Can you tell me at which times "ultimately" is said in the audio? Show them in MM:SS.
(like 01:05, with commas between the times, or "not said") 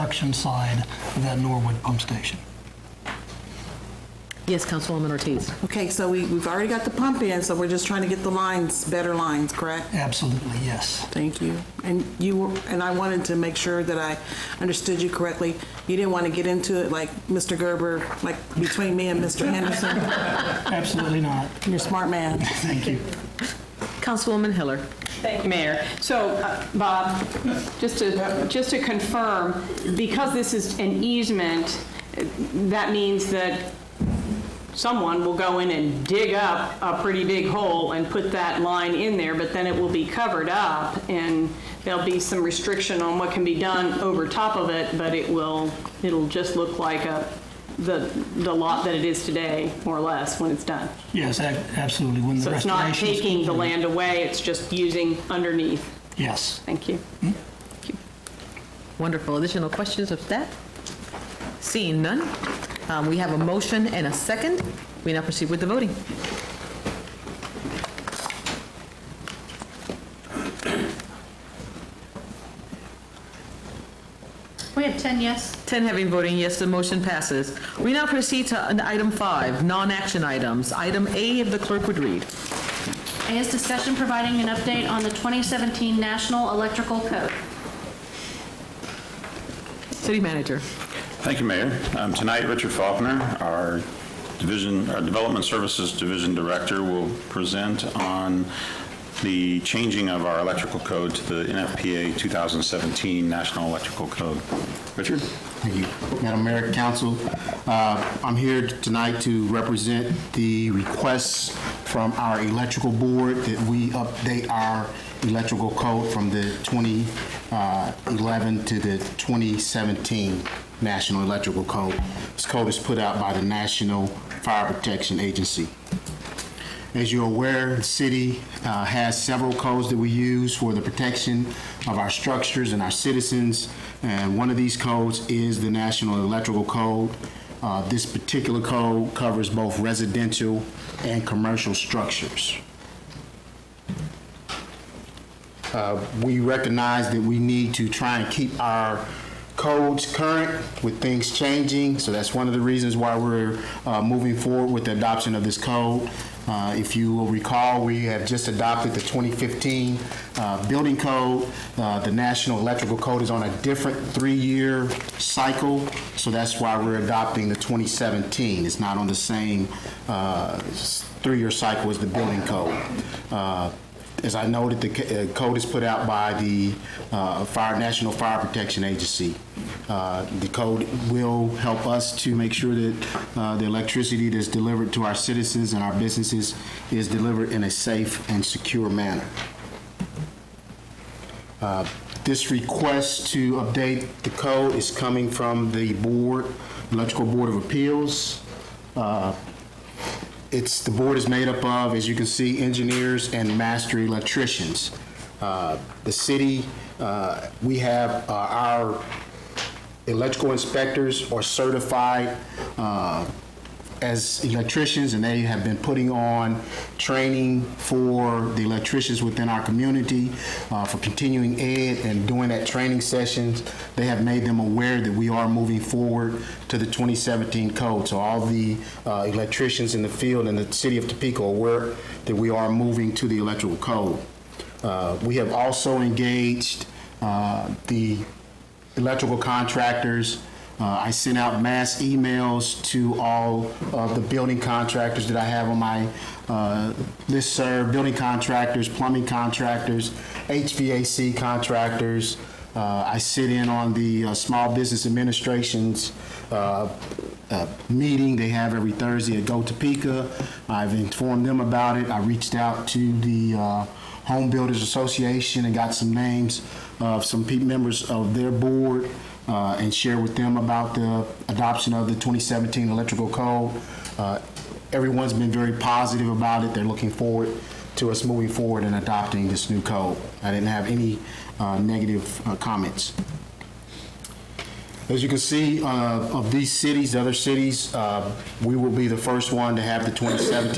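not said.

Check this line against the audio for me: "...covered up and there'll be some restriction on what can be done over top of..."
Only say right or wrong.
right.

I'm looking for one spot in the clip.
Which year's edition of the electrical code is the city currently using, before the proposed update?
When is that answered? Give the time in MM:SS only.
01:56.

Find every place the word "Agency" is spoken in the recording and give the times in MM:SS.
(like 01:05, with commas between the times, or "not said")
02:05, 02:58.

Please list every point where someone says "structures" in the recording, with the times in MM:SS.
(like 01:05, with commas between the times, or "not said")
02:12, 02:21.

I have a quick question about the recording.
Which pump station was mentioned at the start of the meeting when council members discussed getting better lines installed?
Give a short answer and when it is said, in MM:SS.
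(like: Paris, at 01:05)
Norwood, at 00:01.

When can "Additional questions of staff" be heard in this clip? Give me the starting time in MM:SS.
00:59.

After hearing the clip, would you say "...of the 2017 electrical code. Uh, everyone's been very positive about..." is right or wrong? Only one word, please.
right.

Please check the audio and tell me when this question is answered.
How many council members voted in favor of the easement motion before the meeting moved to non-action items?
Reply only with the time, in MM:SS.
01:15.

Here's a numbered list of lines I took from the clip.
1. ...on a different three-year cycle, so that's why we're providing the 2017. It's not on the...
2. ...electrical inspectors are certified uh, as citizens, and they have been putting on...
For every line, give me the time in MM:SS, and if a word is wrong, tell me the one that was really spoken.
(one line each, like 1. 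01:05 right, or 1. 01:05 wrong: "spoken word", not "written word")
1. 02:43 wrong: "adopting", not "providing"
2. 03:30 wrong: "electricians", not "citizens".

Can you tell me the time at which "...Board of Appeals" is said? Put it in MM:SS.
03:17.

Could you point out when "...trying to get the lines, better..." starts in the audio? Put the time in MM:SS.
00:07.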